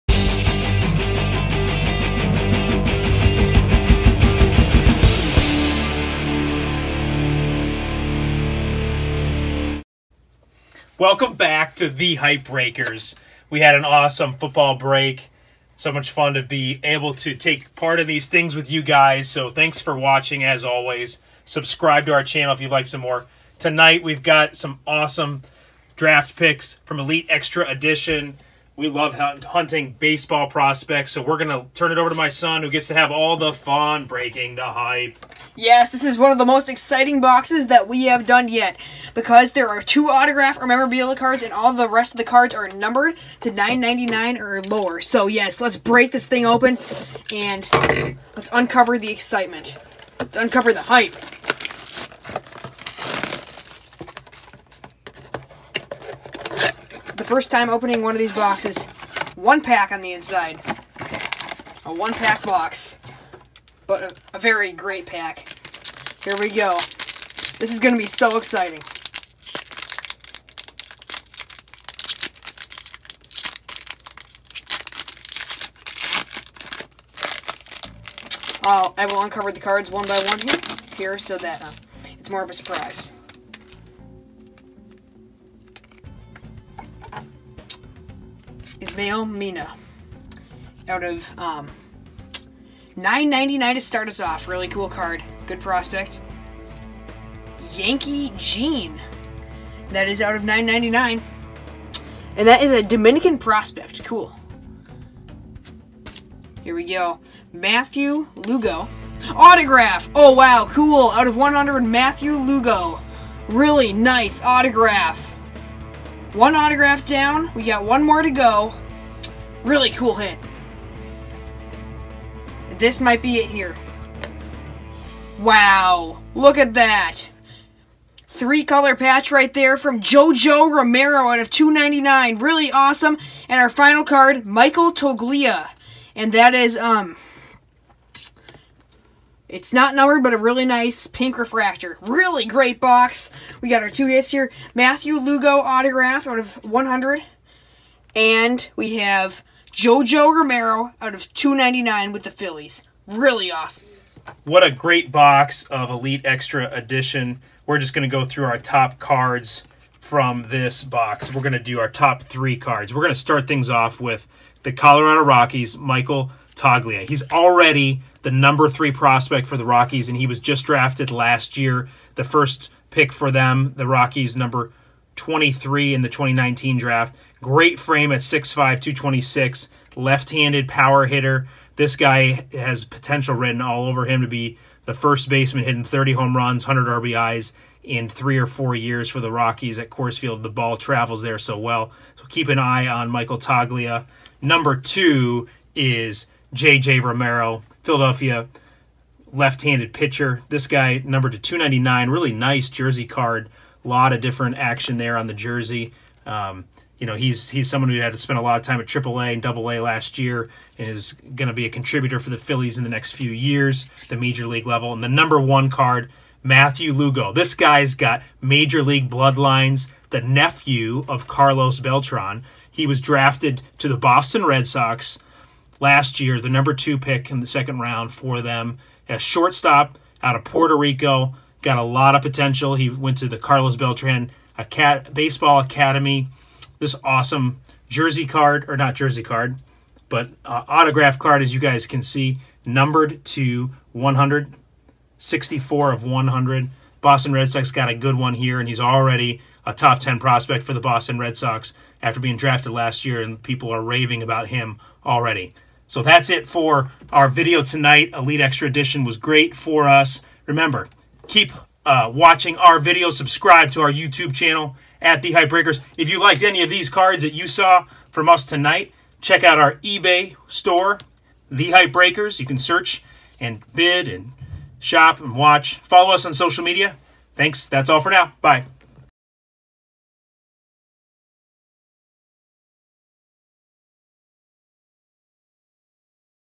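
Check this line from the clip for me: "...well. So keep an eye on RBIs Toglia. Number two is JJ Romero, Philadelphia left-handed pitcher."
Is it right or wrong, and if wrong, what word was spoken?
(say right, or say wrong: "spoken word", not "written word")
wrong: "Michael", not "RBIs".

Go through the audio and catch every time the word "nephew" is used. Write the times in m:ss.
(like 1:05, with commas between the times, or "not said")
3:40.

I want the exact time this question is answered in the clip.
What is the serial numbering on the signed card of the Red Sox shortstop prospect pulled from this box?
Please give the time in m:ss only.
4:05.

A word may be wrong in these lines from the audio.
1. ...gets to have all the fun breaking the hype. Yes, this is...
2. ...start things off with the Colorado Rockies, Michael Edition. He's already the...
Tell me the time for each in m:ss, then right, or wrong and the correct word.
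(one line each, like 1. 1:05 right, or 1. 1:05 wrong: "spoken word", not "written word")
1. 0:32 right
2. 2:43 wrong: "Toglia", not "Edition".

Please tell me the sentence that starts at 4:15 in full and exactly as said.
So that's it for our video tonight.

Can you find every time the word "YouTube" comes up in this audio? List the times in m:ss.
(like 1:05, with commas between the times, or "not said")
4:23.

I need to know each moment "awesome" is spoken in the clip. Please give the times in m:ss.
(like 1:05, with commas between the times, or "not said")
0:13, 0:24, 2:12, 2:33, 3:57.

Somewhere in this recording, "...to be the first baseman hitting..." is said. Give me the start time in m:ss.
3:04.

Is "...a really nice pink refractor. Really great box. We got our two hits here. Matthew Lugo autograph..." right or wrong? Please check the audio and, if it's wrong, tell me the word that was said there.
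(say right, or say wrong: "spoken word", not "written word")
right.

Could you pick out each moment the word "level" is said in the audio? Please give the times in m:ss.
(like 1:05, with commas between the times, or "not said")
3:34.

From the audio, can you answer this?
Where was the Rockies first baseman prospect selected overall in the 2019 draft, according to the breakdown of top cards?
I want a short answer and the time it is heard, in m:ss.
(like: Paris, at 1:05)
Number 23, at 2:54.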